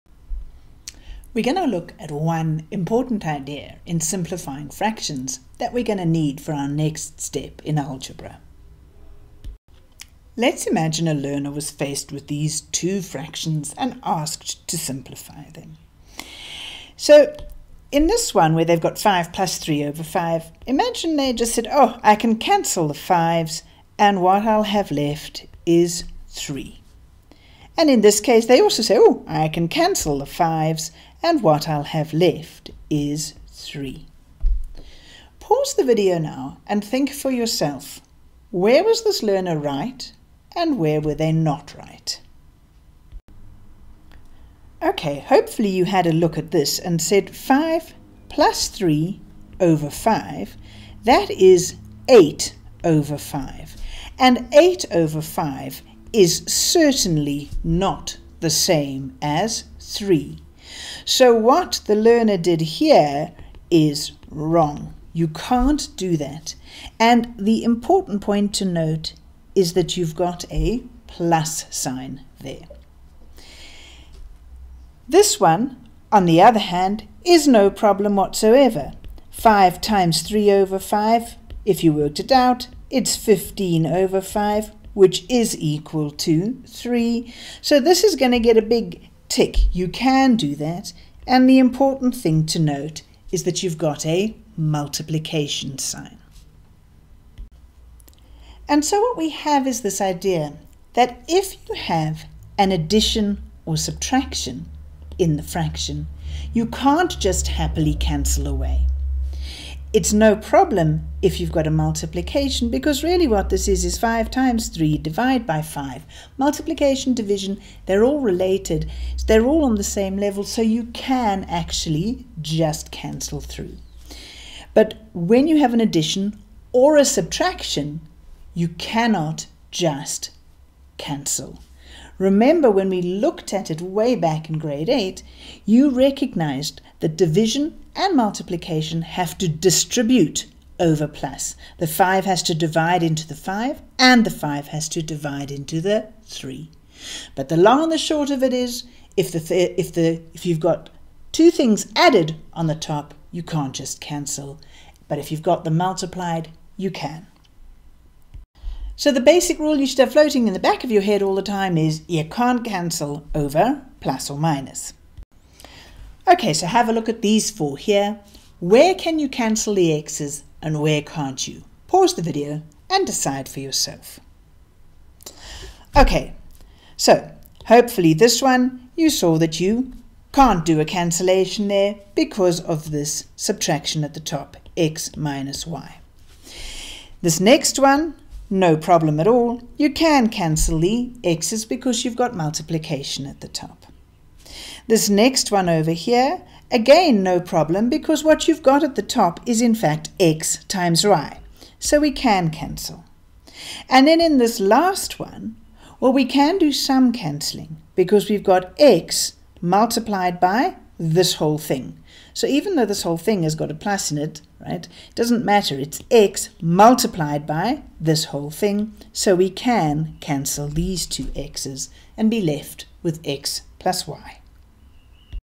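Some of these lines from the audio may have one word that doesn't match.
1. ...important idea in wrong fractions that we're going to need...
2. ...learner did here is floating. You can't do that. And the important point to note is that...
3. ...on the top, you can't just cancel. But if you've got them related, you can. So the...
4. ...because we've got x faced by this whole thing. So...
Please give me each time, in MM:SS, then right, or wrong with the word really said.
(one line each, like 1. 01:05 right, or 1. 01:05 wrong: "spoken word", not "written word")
1. 00:02 wrong: "simplifying", not "wrong"
2. 01:01 wrong: "wrong", not "floating"
3. 02:32 wrong: "multiplied", not "related"
4. 03:27 wrong: "multiplied", not "faced".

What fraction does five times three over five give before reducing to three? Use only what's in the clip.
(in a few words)
15 over 5.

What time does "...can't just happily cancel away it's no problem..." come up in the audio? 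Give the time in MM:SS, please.
01:46.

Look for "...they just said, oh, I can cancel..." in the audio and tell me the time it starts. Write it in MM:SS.
00:21.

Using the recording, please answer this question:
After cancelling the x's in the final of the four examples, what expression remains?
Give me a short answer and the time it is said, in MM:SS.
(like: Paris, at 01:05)
x plus y, at 03:43.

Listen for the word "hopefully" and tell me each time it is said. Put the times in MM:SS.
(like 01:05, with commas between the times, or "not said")
00:45, 02:57.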